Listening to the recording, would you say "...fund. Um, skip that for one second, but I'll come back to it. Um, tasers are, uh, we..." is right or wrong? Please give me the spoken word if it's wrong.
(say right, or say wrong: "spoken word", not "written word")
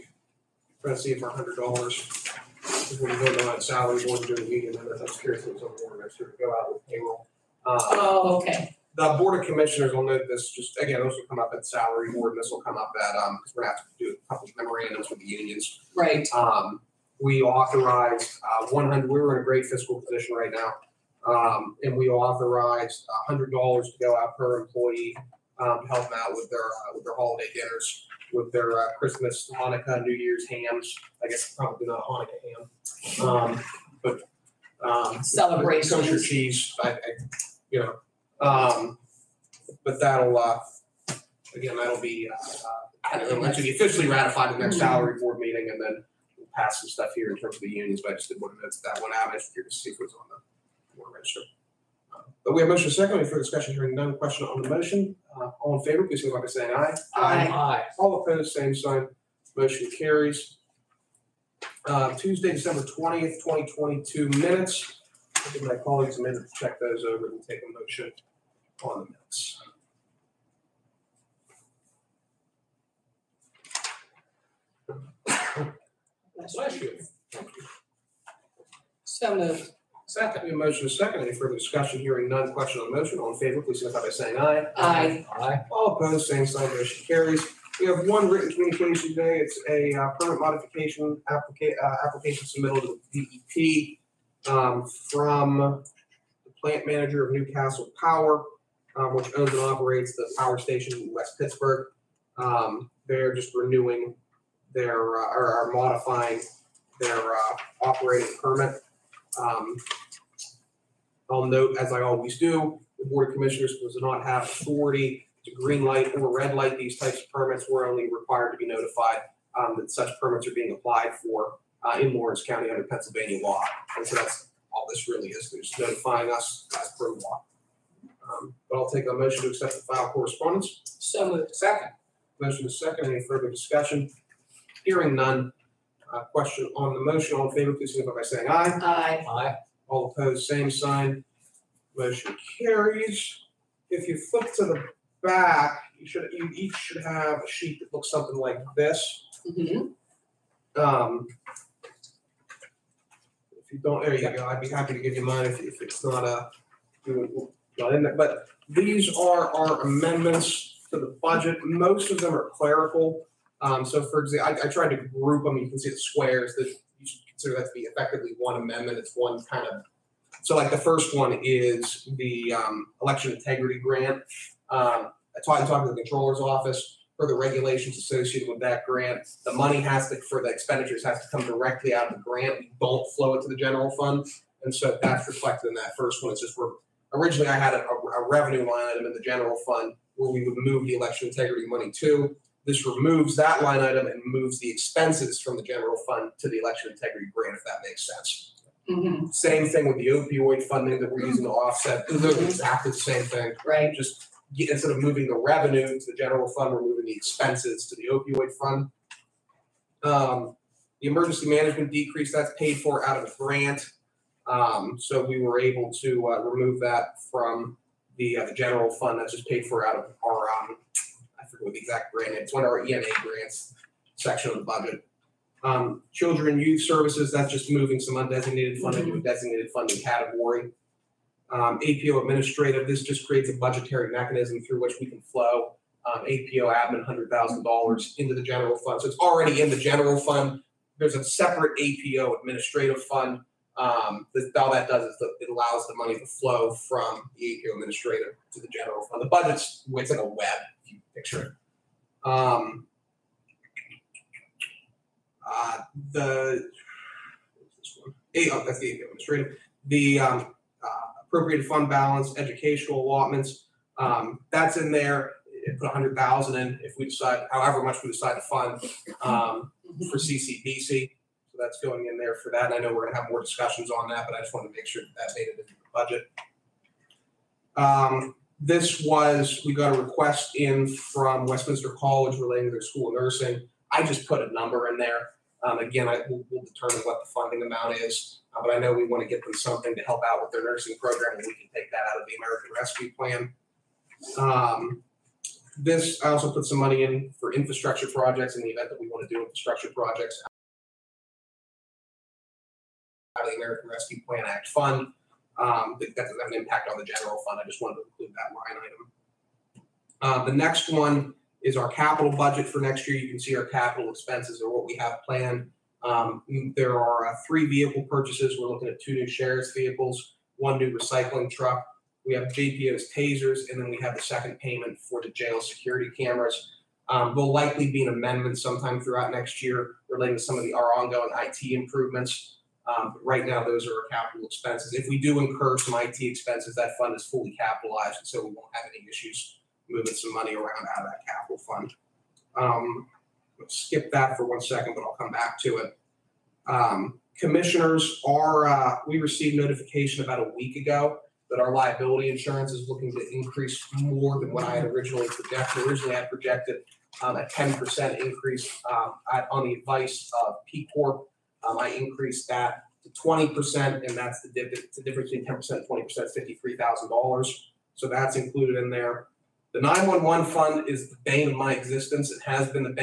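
wrong: "commissioners", not "tasers".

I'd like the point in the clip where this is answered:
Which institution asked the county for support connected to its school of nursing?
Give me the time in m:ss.
4:41.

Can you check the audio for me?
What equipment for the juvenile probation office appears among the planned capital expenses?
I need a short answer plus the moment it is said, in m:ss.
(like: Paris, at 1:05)
tasers, at 5:23.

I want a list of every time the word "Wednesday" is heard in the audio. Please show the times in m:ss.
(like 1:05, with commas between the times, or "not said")
not said.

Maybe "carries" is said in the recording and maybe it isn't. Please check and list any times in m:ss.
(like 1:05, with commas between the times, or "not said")
0:59, 1:27, 2:22.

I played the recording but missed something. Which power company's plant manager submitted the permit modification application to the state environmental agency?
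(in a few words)
Newcastle Power.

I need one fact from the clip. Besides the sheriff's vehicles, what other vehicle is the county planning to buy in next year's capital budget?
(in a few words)
recycling truck.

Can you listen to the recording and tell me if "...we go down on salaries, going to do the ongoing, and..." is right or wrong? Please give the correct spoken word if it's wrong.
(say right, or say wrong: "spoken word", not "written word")
wrong: "meeting", not "ongoing".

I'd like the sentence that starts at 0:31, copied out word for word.
I guess probably not Hanukkah ham.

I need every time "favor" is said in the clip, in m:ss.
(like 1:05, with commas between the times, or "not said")
0:55, 1:23, 2:17.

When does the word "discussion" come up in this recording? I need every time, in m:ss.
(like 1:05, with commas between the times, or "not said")
0:53, 1:21, 2:13, 4:33.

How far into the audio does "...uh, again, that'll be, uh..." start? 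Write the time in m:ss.
0:40.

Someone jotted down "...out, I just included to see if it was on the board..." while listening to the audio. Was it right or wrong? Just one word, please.
wrong.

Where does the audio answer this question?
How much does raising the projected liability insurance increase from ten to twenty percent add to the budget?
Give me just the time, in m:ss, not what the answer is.
6:06.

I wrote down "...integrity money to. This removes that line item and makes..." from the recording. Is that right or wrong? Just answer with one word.
wrong.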